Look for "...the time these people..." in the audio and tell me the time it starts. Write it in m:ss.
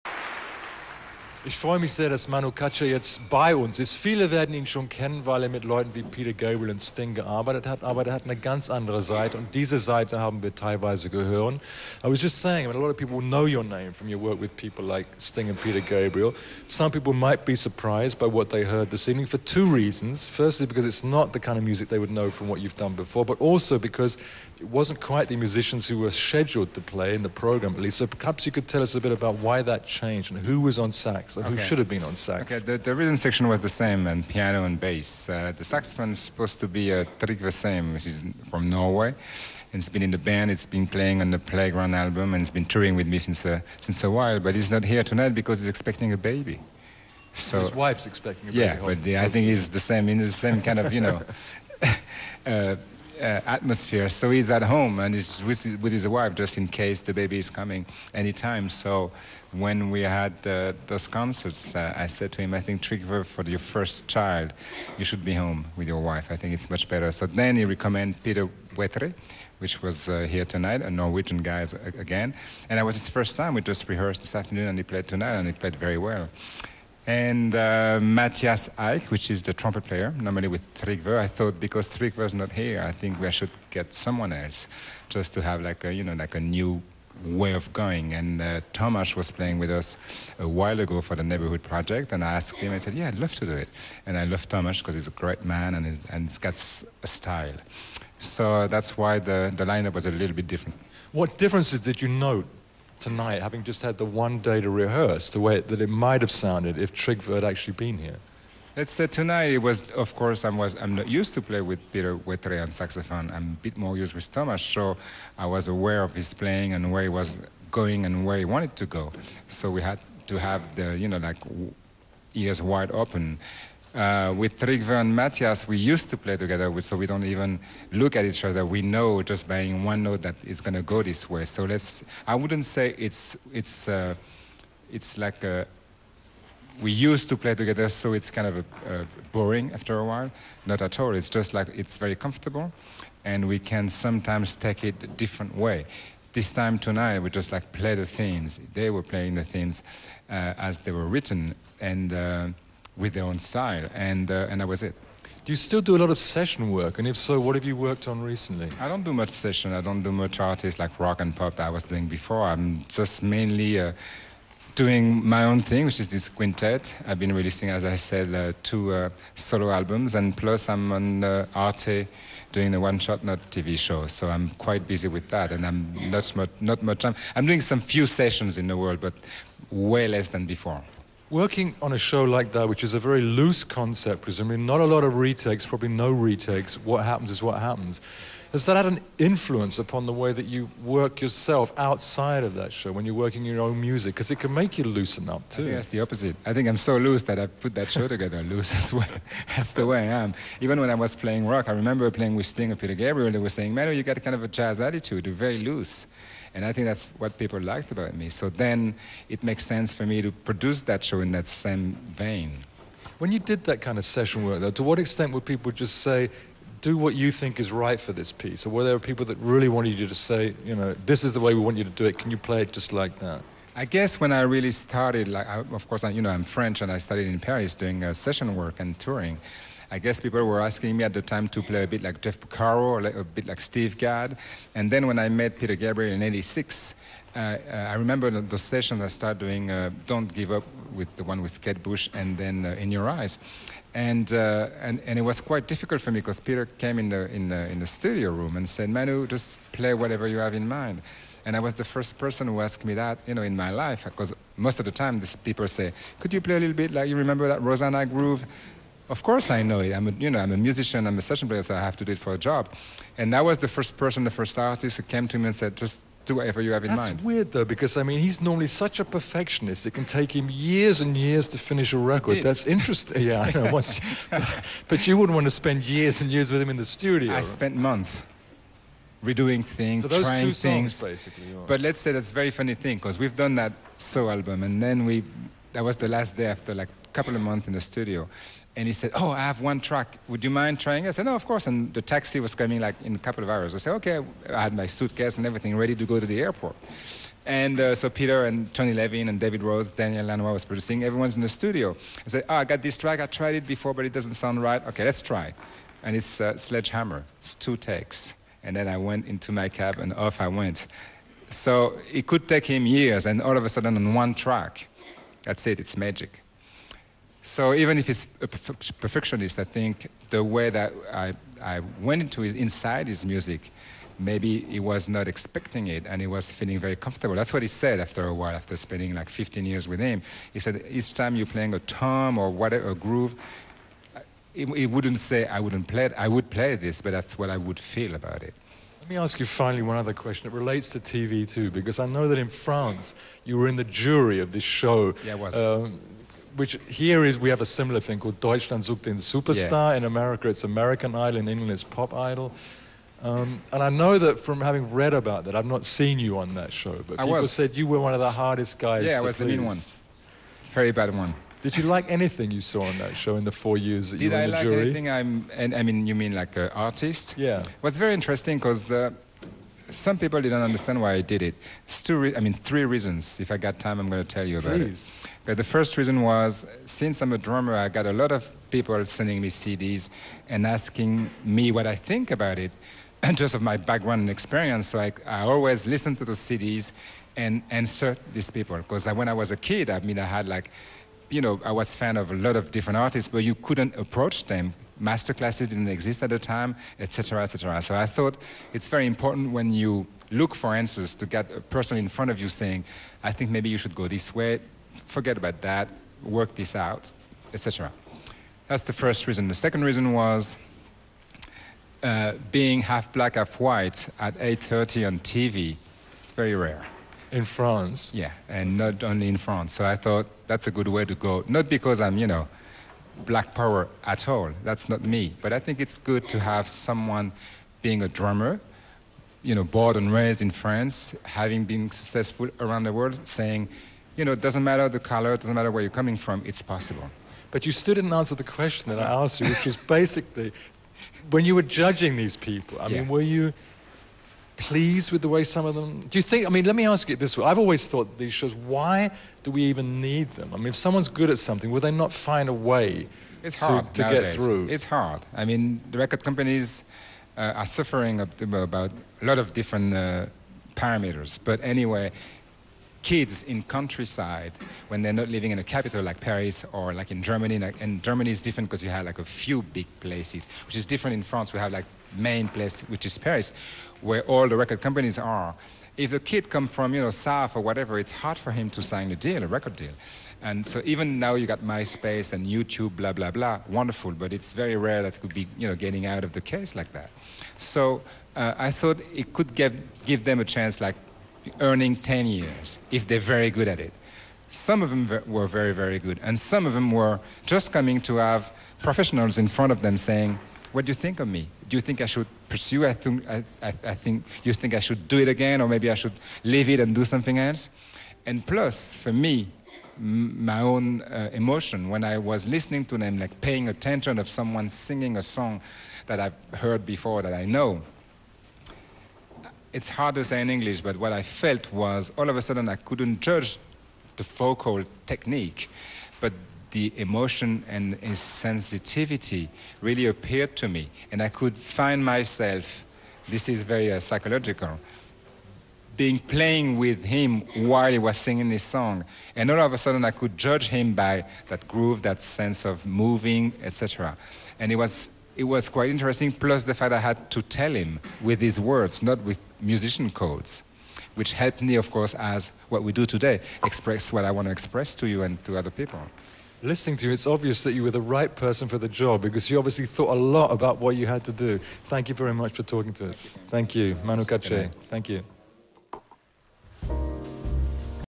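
4:14.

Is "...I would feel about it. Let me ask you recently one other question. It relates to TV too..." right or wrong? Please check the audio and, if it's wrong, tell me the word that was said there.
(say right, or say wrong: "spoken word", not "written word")
wrong: "finally", not "recently".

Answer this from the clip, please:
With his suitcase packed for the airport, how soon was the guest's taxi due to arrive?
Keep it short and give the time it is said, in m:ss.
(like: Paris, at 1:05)
A couple of hours, at 4:53.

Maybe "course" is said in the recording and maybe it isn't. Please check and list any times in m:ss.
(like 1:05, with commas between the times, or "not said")
1:50, 3:45, 4:19, 4:51, 9:11.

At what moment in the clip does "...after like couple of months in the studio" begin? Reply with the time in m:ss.
4:46.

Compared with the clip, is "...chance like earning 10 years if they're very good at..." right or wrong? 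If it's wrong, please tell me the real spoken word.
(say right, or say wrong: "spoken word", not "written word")
right.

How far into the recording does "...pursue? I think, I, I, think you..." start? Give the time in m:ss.
8:22.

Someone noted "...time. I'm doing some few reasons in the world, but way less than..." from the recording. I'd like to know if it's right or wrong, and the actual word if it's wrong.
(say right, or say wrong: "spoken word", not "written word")
wrong: "sessions", not "reasons".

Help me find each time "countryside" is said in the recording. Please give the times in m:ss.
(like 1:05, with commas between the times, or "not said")
7:43.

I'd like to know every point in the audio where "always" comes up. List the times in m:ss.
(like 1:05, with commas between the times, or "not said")
6:25, 7:27.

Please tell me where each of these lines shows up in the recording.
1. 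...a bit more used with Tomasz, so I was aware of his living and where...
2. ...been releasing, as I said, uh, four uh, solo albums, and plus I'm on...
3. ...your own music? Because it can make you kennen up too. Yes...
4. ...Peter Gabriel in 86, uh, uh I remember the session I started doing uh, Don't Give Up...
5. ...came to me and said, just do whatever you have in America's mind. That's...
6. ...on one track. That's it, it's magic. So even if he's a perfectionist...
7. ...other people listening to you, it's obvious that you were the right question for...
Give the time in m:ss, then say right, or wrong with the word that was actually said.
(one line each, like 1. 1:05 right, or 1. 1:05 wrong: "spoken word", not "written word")
1. 1:53 wrong: "playing", not "living"
2. 2:47 wrong: "two", not "four"
3. 3:13 wrong: "loosen", not "kennen"
4. 3:55 right
5. 4:25 wrong: "That", not "America"
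6. 5:13 right
7. 9:15 wrong: "person", not "question".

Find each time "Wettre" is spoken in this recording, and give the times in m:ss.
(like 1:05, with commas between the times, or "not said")
1:08, 1:52.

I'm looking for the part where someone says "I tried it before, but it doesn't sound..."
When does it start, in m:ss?
5:03.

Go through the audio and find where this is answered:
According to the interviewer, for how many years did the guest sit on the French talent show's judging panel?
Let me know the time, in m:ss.
6:03.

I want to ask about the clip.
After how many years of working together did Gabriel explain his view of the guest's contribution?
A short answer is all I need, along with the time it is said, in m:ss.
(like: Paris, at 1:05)
15, at 5:29.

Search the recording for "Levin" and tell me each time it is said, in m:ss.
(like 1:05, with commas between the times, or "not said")
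4:58.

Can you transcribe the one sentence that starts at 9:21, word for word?
Thank you very much for talking to us.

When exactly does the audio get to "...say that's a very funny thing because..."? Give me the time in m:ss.
4:41.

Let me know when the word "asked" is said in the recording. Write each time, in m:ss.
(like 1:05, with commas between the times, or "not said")
1:32, 4:12, 7:19.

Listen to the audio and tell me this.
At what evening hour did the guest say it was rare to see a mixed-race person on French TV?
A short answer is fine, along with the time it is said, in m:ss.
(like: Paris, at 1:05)
8:30, at 6:54.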